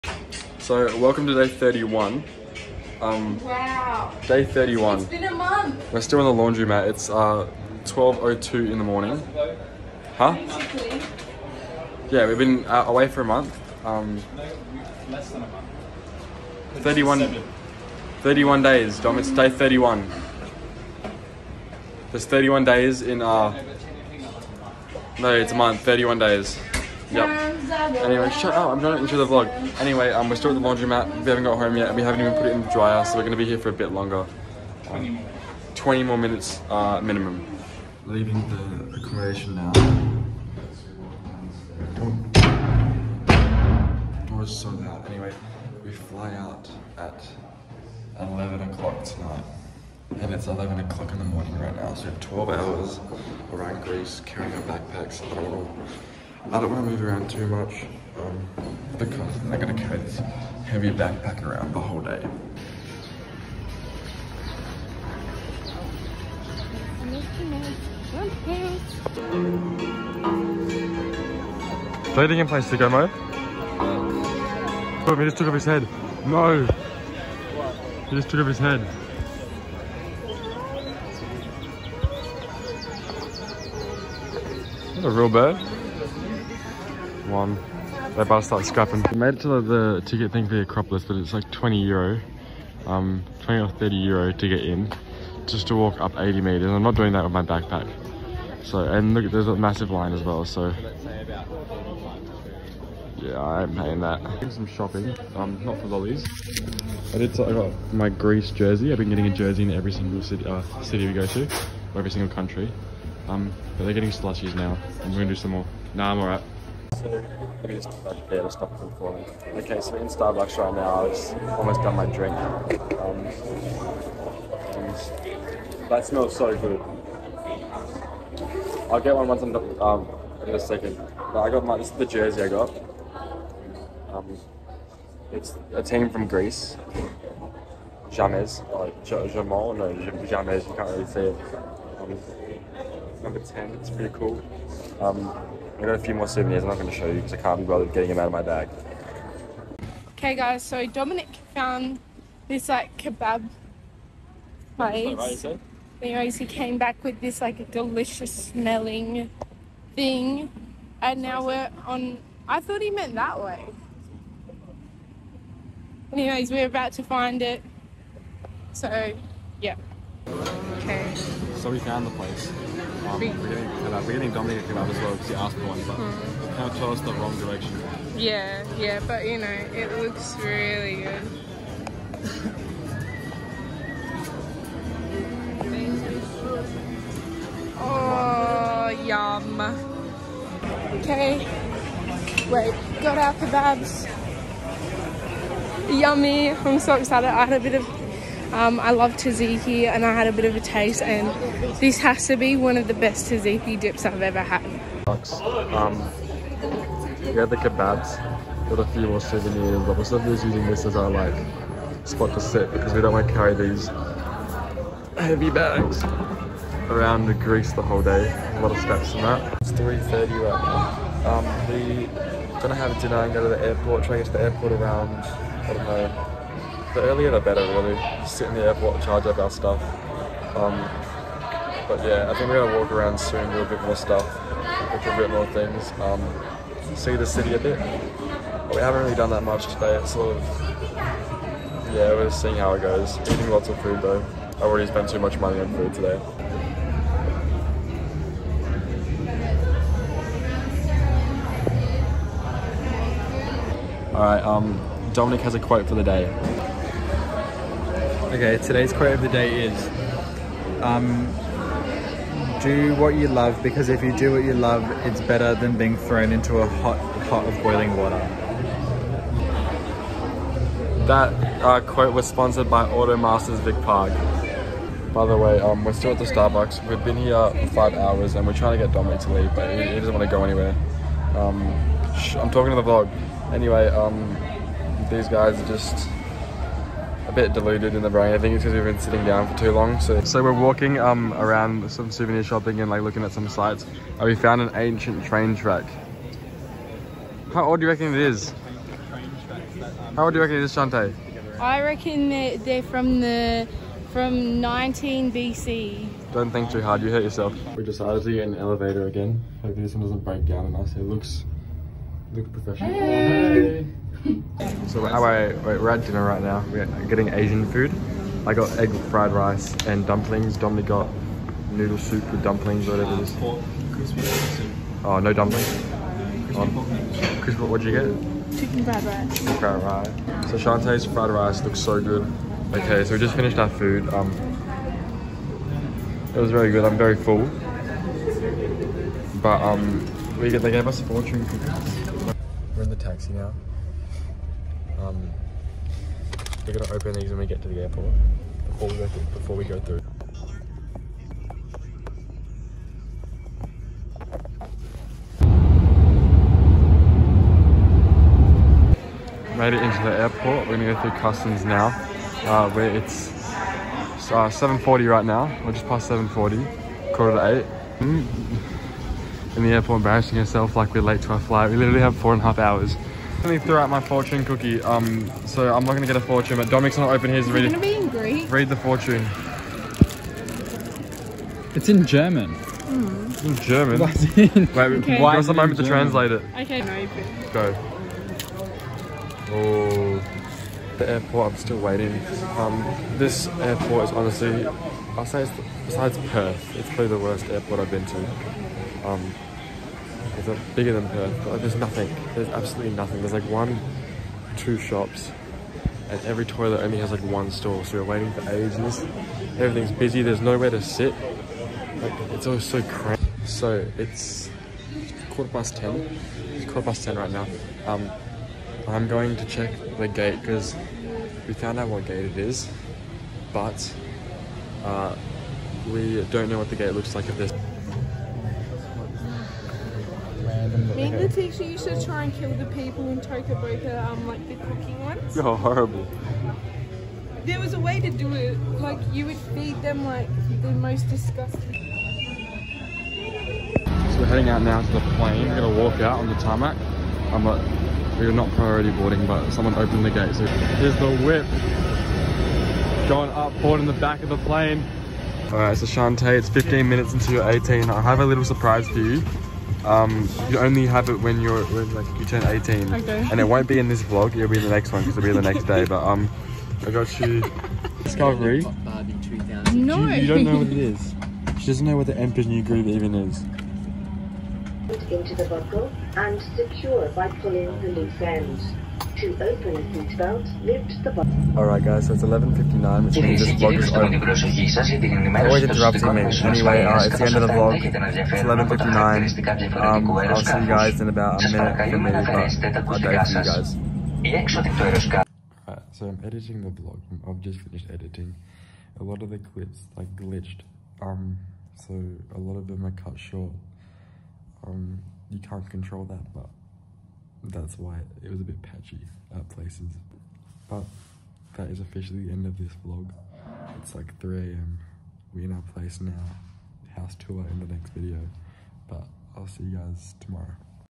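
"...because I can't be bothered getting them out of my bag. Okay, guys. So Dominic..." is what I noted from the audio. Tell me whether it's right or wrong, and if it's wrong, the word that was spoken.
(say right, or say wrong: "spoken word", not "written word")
right.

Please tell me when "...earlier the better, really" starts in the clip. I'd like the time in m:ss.
3:47.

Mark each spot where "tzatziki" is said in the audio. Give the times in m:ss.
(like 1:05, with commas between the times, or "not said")
3:19, 3:23.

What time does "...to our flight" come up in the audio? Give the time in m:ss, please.
6:11.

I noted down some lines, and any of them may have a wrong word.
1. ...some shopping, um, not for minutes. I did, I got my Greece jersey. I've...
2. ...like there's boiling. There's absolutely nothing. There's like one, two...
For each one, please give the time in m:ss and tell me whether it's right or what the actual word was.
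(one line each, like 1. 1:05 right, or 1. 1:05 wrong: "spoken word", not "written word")
1. 1:44 wrong: "lollies", not "minutes"
2. 6:41 wrong: "nothing", not "boiling".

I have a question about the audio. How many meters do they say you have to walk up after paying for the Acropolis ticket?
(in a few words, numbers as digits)
80 meters.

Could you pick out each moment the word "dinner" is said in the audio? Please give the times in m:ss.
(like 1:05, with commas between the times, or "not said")
3:43, 5:16.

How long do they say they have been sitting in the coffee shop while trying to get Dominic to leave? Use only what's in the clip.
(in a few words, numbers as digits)
5 hours.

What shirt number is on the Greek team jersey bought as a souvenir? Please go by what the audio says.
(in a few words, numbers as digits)
10.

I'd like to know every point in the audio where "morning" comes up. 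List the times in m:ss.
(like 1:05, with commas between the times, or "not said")
0:08, 0:51.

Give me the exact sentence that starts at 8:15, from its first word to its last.
Right, so I'm editing the vlog.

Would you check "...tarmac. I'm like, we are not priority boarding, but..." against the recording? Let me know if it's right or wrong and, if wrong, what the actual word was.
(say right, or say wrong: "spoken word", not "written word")
right.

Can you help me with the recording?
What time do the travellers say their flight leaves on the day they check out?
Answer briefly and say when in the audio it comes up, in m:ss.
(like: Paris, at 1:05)
11 o'clock tonight, at 0:48.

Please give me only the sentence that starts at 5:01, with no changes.
I reckon they're, they're from the from 19 BC.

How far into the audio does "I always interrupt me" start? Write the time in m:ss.
8:05.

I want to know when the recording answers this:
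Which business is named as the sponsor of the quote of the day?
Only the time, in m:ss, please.
4:32.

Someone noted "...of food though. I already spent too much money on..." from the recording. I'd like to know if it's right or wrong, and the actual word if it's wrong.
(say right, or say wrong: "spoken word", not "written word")
right.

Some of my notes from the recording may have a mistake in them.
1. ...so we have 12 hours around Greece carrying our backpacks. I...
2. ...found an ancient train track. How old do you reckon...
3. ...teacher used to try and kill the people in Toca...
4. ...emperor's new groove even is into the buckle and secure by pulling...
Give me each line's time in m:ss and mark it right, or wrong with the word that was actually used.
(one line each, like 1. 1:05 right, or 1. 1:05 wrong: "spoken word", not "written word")
1. 0:51 right
2. 4:54 right
3. 7:11 right
4. 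7:52 right.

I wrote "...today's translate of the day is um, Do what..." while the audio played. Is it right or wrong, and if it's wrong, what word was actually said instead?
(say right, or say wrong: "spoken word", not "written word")
wrong: "quote", not "translate".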